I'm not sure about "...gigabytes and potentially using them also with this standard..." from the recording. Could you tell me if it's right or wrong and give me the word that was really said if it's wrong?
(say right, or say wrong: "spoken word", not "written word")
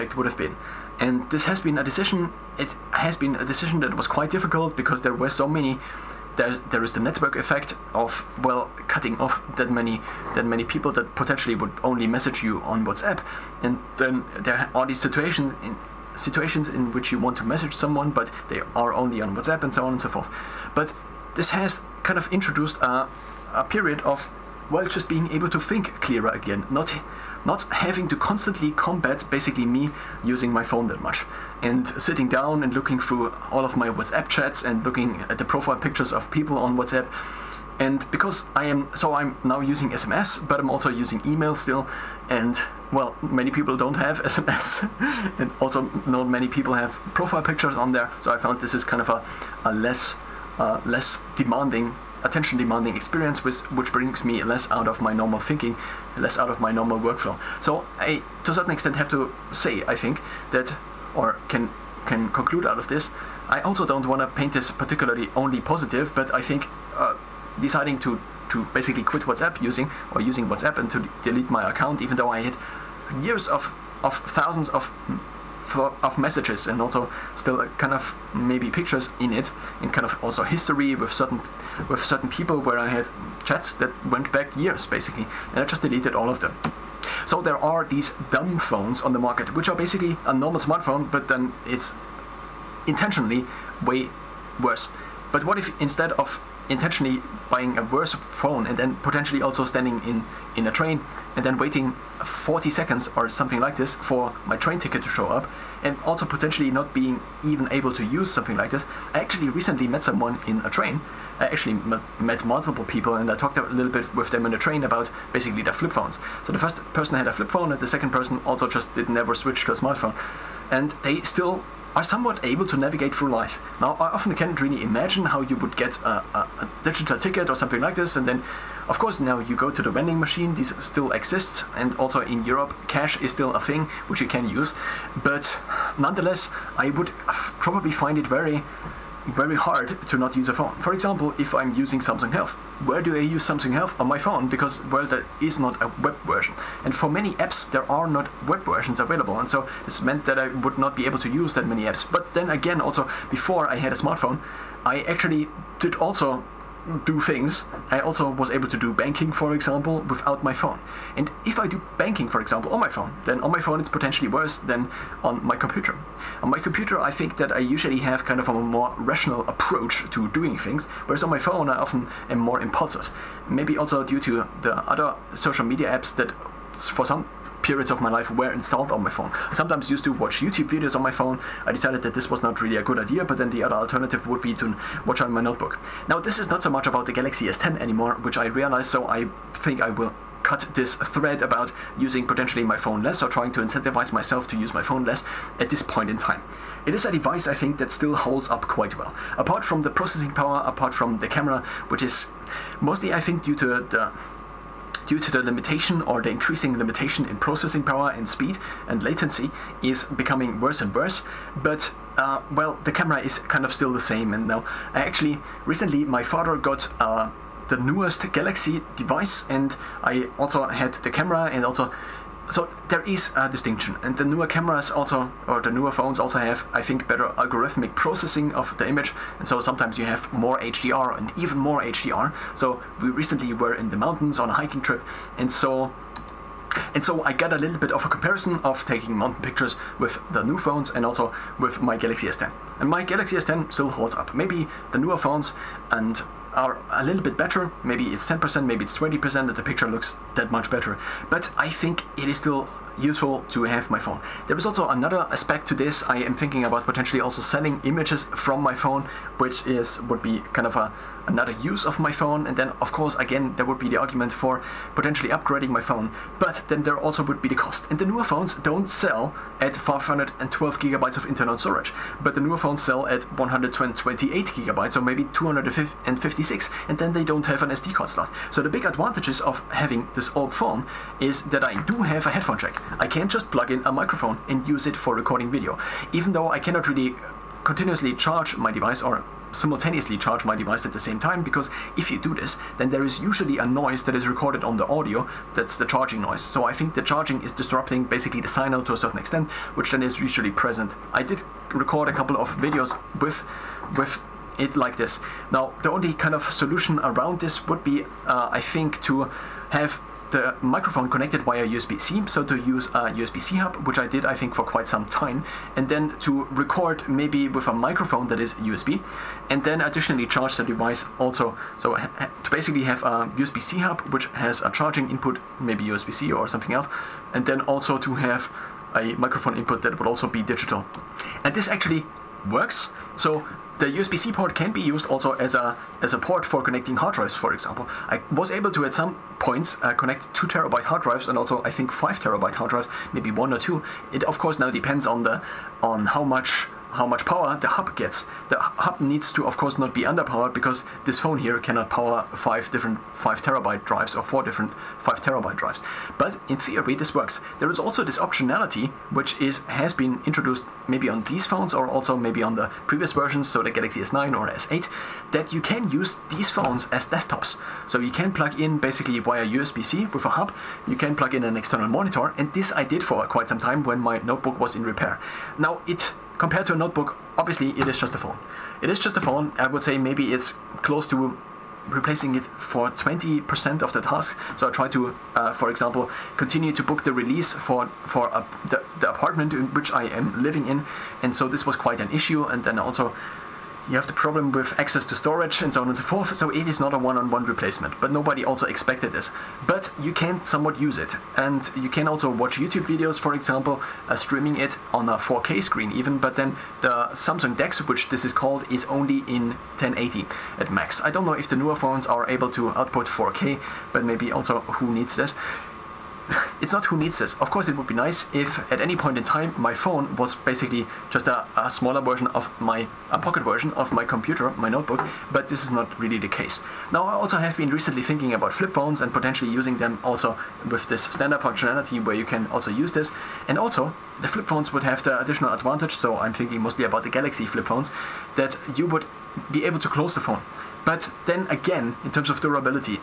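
wrong: "phones", not "gigabytes".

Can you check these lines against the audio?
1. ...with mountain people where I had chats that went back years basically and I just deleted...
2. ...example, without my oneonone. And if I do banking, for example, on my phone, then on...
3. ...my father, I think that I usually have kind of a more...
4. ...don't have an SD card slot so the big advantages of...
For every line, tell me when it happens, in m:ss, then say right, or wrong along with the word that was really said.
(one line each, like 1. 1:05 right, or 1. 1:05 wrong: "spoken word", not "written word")
1. 1:21 wrong: "certain", not "mountain"
2. 2:39 wrong: "phone", not "oneonone"
3. 2:46 wrong: "computer", not "father"
4. 4:37 right.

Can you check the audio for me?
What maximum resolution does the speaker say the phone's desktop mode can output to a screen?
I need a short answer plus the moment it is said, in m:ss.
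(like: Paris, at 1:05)
1080, at 6:49.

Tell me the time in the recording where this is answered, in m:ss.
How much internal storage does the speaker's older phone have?
4:29.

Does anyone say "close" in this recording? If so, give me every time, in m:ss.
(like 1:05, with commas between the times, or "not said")
6:20, 7:19.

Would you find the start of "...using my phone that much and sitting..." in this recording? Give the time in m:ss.
0:30.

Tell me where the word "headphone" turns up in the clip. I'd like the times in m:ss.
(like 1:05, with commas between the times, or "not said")
4:42.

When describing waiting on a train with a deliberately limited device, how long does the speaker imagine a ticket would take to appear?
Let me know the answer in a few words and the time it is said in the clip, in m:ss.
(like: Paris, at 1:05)
40 seconds, at 1:42.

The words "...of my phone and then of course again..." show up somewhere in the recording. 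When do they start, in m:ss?
4:21.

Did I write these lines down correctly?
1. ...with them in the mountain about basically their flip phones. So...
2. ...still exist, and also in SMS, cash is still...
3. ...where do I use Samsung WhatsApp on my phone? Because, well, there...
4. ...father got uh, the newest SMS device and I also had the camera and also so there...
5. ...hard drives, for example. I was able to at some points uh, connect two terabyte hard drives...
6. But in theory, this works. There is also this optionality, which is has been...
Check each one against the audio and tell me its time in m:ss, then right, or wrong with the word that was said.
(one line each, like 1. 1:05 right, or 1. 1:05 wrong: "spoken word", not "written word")
1. 1:54 wrong: "train", not "mountain"
2. 2:10 wrong: "Europe", not "SMS"
3. 2:22 wrong: "Health", not "WhatsApp"
4. 3:36 wrong: "Galaxy", not "SMS"
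5. 5:36 right
6. 5:56 right.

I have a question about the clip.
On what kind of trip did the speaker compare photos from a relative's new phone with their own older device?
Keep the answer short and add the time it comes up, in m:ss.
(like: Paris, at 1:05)
hiking trip, at 3:54.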